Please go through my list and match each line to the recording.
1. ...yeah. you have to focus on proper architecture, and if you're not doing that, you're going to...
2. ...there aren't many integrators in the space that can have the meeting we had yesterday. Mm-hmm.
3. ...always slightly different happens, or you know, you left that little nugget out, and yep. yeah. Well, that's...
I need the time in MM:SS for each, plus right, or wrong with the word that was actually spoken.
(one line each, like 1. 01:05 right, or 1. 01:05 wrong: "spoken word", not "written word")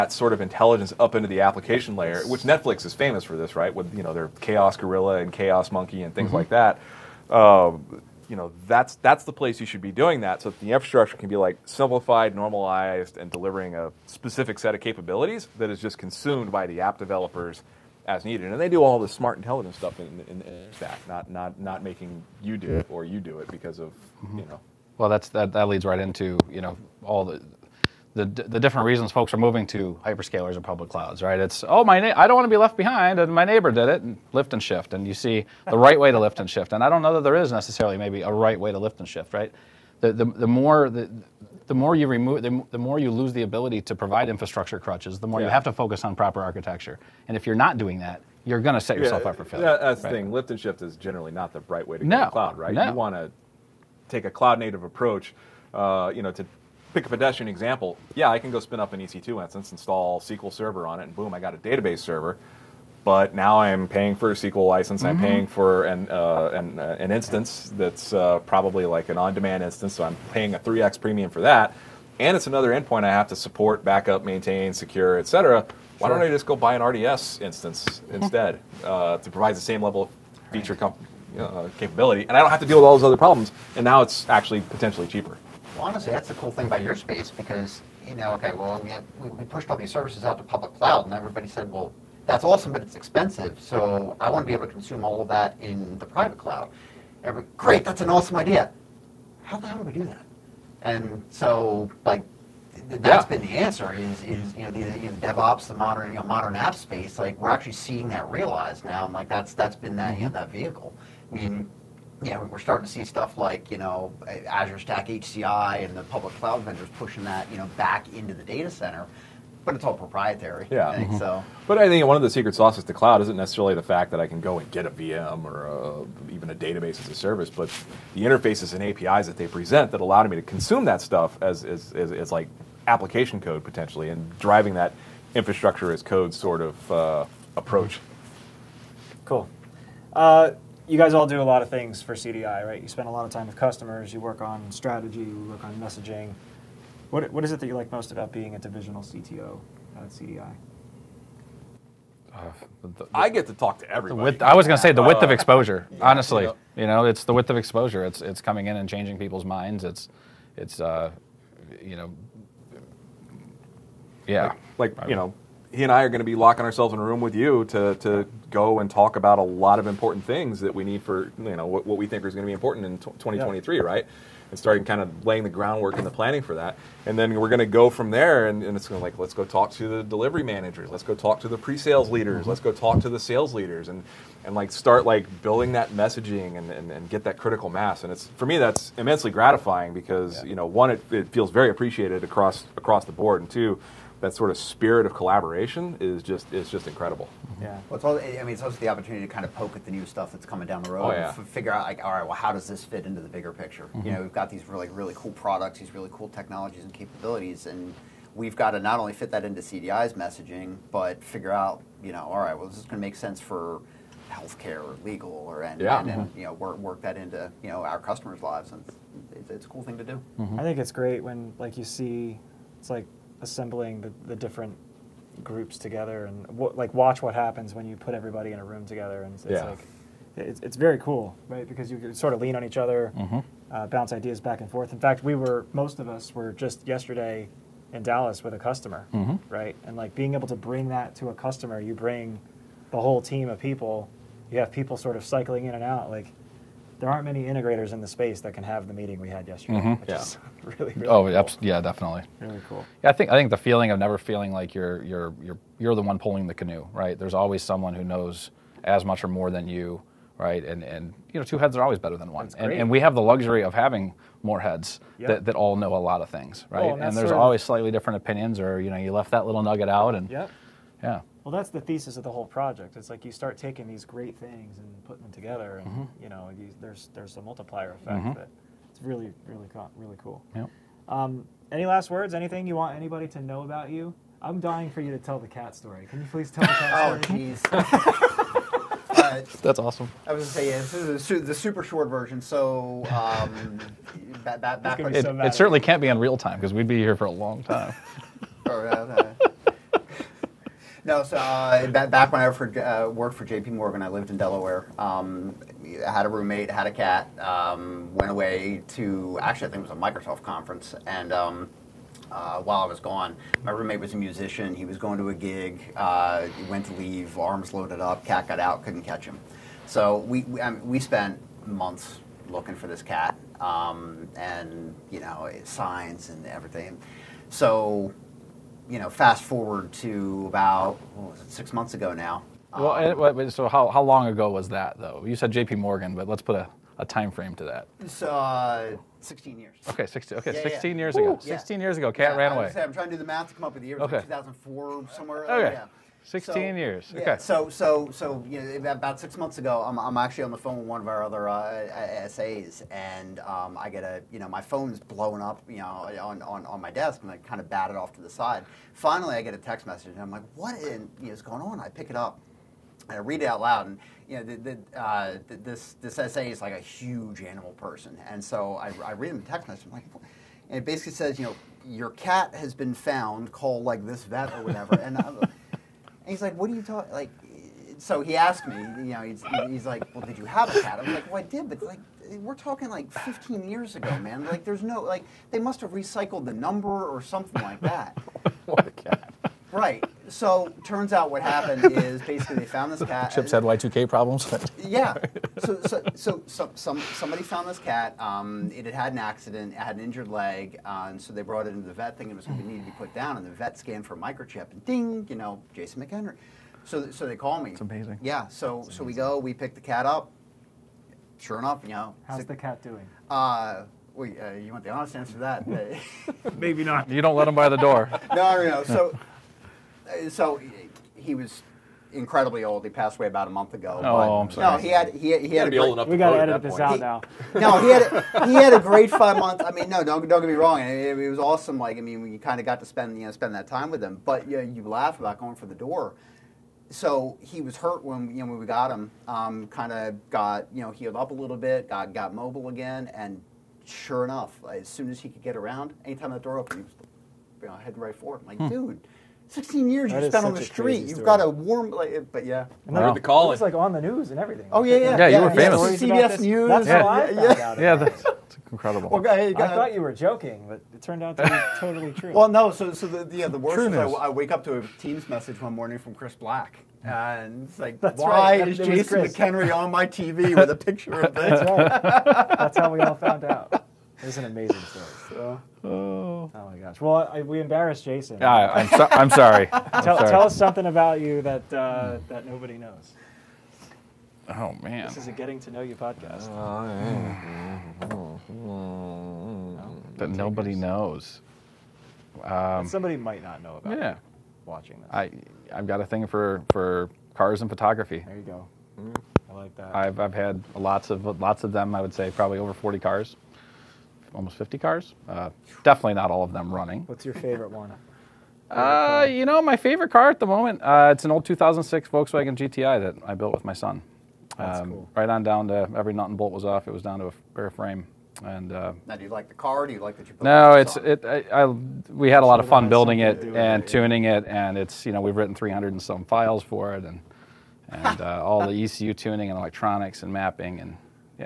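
1. 00:45 right
2. 04:07 right
3. 04:27 wrong: "opinions", not "happens".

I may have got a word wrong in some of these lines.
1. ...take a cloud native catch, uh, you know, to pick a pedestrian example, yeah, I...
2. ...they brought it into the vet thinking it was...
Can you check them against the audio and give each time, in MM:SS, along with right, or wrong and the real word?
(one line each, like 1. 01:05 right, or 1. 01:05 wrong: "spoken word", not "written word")
1. 00:54 wrong: "approach", not "catch"
2. 06:41 right.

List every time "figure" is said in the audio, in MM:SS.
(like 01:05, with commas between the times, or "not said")
03:21, 03:31.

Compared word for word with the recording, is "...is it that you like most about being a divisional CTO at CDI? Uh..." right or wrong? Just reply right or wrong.
right.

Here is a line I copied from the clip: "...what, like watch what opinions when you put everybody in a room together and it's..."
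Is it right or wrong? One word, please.
wrong.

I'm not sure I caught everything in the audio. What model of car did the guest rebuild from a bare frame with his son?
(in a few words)
Volkswagen GTI.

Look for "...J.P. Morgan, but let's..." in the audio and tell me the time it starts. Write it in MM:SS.
05:35.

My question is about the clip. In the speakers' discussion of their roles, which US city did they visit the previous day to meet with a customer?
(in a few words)
Dallas.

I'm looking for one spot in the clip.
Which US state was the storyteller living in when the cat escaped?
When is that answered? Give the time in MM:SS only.
05:04.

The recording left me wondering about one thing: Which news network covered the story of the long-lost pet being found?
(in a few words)
CBS News.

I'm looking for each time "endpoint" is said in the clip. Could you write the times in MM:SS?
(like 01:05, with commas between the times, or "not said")
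01:12.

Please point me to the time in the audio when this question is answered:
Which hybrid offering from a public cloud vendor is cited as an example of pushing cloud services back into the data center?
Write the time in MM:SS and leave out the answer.
01:54.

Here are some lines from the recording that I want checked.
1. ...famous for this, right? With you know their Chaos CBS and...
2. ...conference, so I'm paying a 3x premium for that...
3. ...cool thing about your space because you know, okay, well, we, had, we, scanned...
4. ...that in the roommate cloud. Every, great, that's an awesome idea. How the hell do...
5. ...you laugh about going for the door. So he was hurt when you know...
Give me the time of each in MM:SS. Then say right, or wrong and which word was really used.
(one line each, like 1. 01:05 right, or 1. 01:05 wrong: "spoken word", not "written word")
1. 00:02 wrong: "Gorilla", not "CBS"
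2. 01:09 wrong: "instance", not "conference"
3. 01:26 wrong: "pushed", not "scanned"
4. 01:35 wrong: "private", not "roommate"
5. 07:14 right.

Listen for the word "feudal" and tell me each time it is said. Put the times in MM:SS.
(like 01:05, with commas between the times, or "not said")
not said.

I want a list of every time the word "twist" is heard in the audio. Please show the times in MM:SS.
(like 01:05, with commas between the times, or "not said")
not said.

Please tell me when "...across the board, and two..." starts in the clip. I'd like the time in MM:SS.
03:12.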